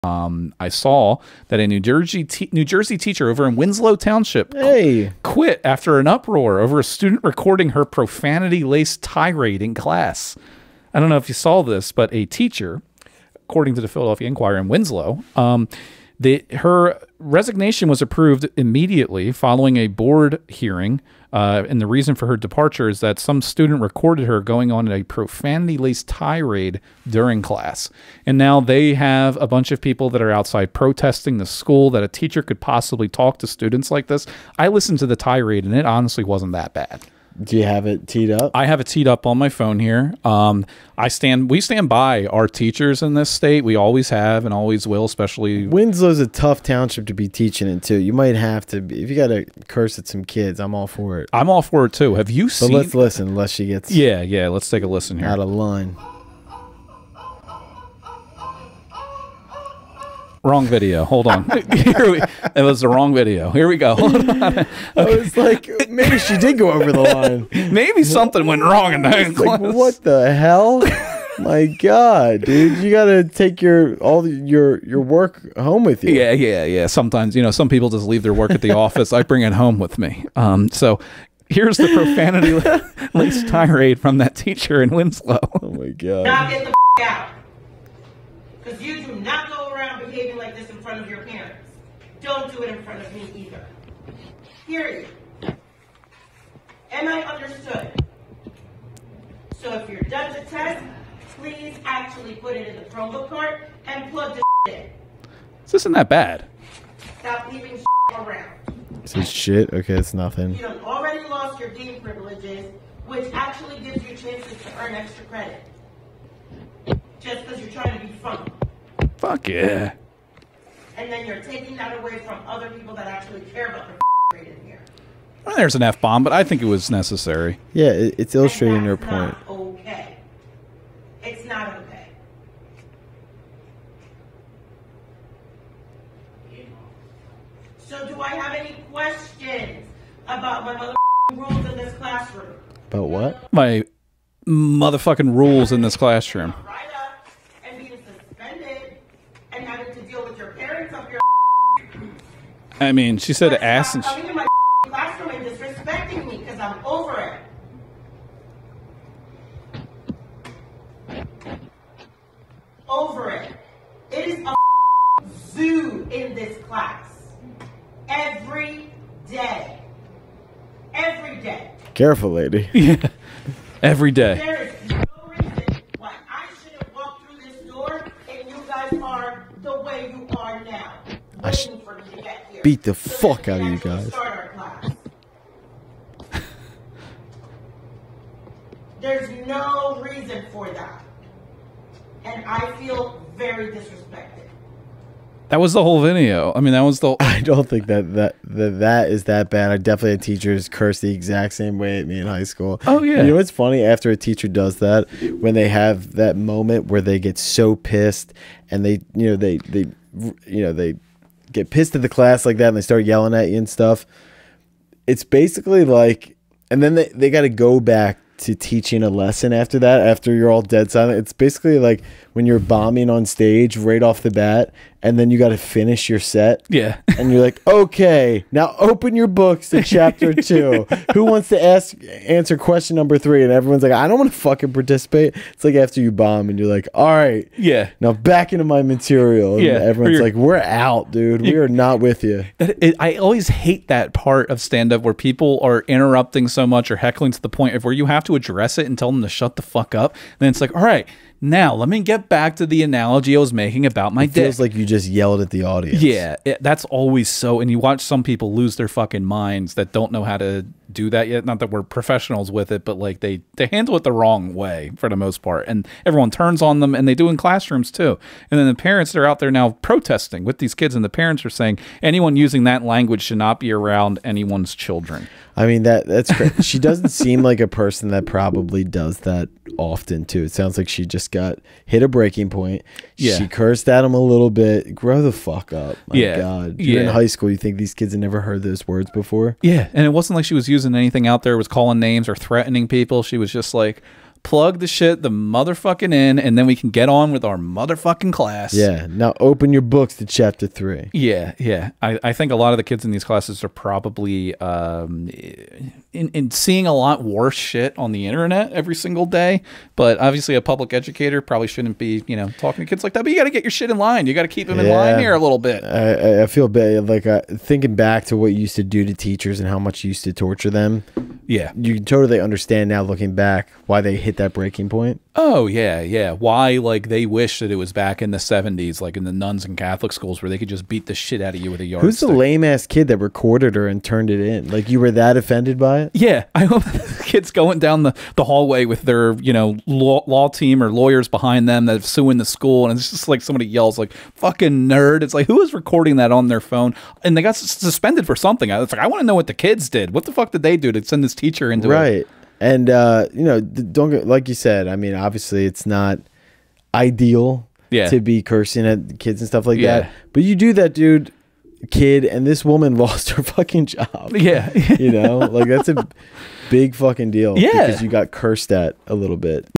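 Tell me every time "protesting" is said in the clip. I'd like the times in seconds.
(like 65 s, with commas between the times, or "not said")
30 s, 269 s.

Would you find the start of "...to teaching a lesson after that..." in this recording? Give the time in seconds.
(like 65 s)
218 s.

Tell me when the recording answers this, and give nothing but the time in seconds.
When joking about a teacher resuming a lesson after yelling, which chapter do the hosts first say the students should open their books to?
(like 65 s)
229 s.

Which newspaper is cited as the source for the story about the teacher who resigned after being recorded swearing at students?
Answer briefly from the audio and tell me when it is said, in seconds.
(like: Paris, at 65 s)
Philadelphia Inquirer, at 13 s.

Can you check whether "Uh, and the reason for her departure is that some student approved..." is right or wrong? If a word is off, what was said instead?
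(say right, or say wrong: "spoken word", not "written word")
wrong: "recorded", not "approved".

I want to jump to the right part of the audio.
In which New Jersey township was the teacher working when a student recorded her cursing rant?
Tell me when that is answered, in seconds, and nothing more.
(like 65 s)
3 s.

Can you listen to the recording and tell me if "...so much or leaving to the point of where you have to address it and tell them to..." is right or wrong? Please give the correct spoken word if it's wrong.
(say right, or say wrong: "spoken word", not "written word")
wrong: "heckling", not "leaving".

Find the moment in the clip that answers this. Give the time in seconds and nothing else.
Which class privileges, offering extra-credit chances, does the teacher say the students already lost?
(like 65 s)
111 s.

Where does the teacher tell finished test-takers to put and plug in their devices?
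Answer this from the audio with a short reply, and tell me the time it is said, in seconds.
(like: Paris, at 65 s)
Chromebook cart, at 102 s.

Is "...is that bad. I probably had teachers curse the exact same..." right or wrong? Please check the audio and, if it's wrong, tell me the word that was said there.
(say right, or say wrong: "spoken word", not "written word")
wrong: "definitely", not "probably".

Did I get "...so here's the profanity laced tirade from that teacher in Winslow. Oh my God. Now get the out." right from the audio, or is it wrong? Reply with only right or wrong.
right.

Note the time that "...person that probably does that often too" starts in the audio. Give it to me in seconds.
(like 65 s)
277 s.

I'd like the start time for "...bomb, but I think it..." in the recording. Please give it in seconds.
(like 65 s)
126 s.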